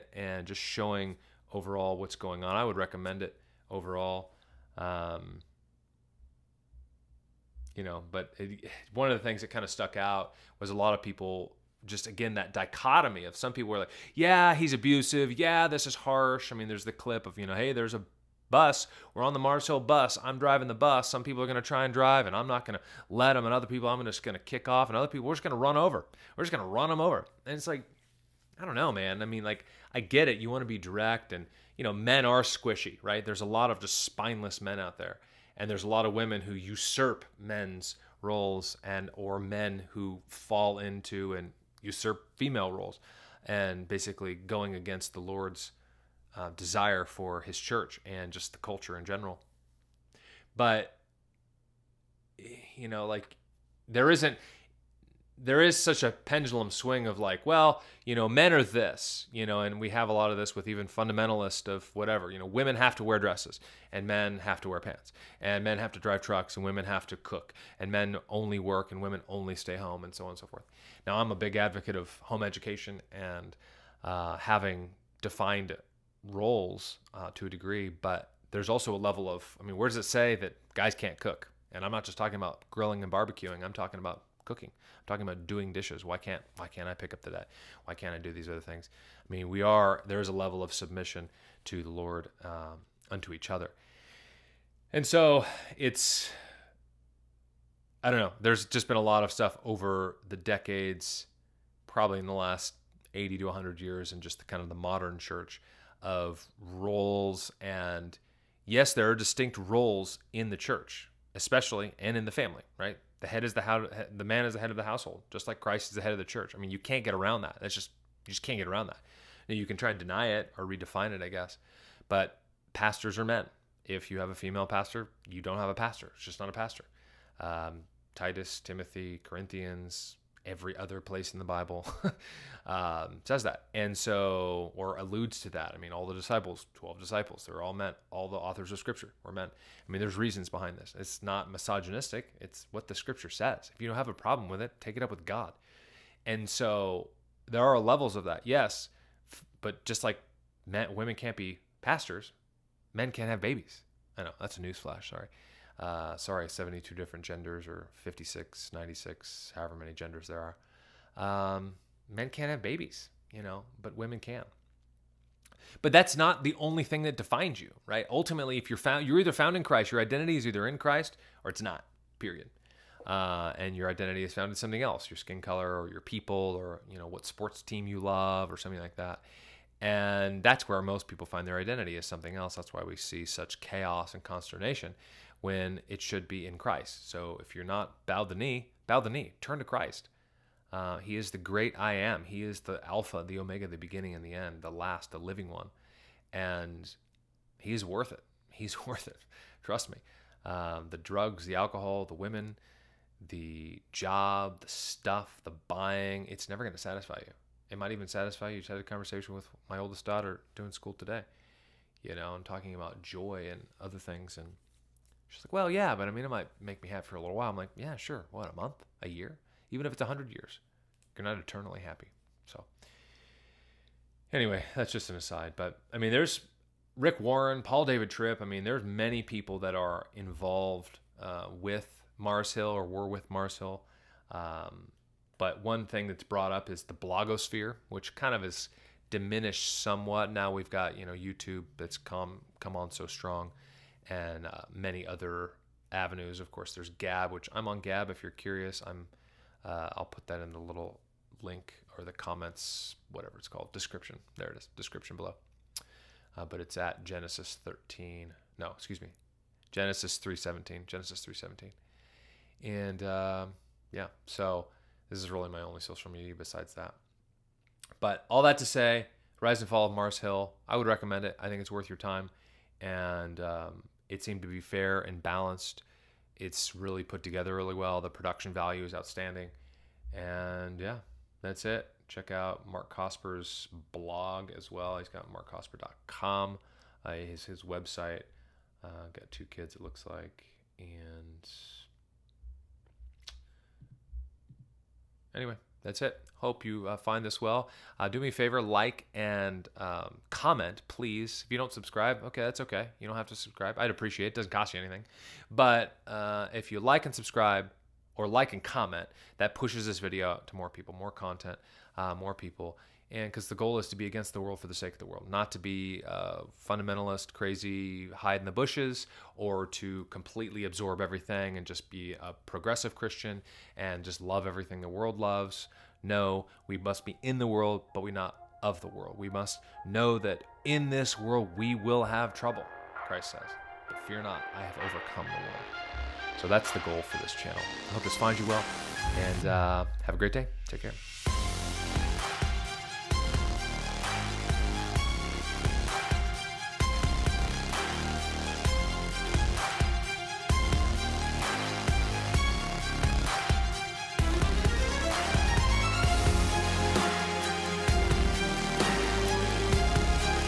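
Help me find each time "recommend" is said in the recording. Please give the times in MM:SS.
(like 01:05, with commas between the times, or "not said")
00:02, 04:30.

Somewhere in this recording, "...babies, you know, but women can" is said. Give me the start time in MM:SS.
02:42.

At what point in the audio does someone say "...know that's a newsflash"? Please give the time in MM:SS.
02:34.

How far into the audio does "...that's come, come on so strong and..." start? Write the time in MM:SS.
04:01.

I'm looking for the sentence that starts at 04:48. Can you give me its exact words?
Uh, got two kids, it looks like.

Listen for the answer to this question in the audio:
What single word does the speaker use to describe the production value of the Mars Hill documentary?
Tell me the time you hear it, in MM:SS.
04:38.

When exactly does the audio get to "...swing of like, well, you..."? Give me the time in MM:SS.
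00:56.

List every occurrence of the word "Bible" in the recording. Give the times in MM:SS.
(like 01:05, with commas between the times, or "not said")
02:11.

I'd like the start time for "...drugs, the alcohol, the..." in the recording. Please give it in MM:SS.
03:20.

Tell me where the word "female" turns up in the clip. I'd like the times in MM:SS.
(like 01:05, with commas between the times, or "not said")
00:42, 02:04.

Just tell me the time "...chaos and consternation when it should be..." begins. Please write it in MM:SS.
03:03.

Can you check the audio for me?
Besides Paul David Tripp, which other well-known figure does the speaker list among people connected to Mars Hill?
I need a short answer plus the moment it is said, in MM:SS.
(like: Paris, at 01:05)
Rick Warren, at 03:46.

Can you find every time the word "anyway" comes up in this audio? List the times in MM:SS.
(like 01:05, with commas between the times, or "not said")
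03:44, 04:55.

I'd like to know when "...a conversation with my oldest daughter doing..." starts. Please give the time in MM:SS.
03:28.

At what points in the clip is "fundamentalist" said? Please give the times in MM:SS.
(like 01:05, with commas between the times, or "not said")
01:00, 05:16.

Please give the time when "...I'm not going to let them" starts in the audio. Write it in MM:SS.
00:22.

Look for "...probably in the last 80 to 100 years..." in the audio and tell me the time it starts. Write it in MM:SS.
01:41.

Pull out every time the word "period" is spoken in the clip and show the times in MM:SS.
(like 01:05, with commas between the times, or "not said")
02:52.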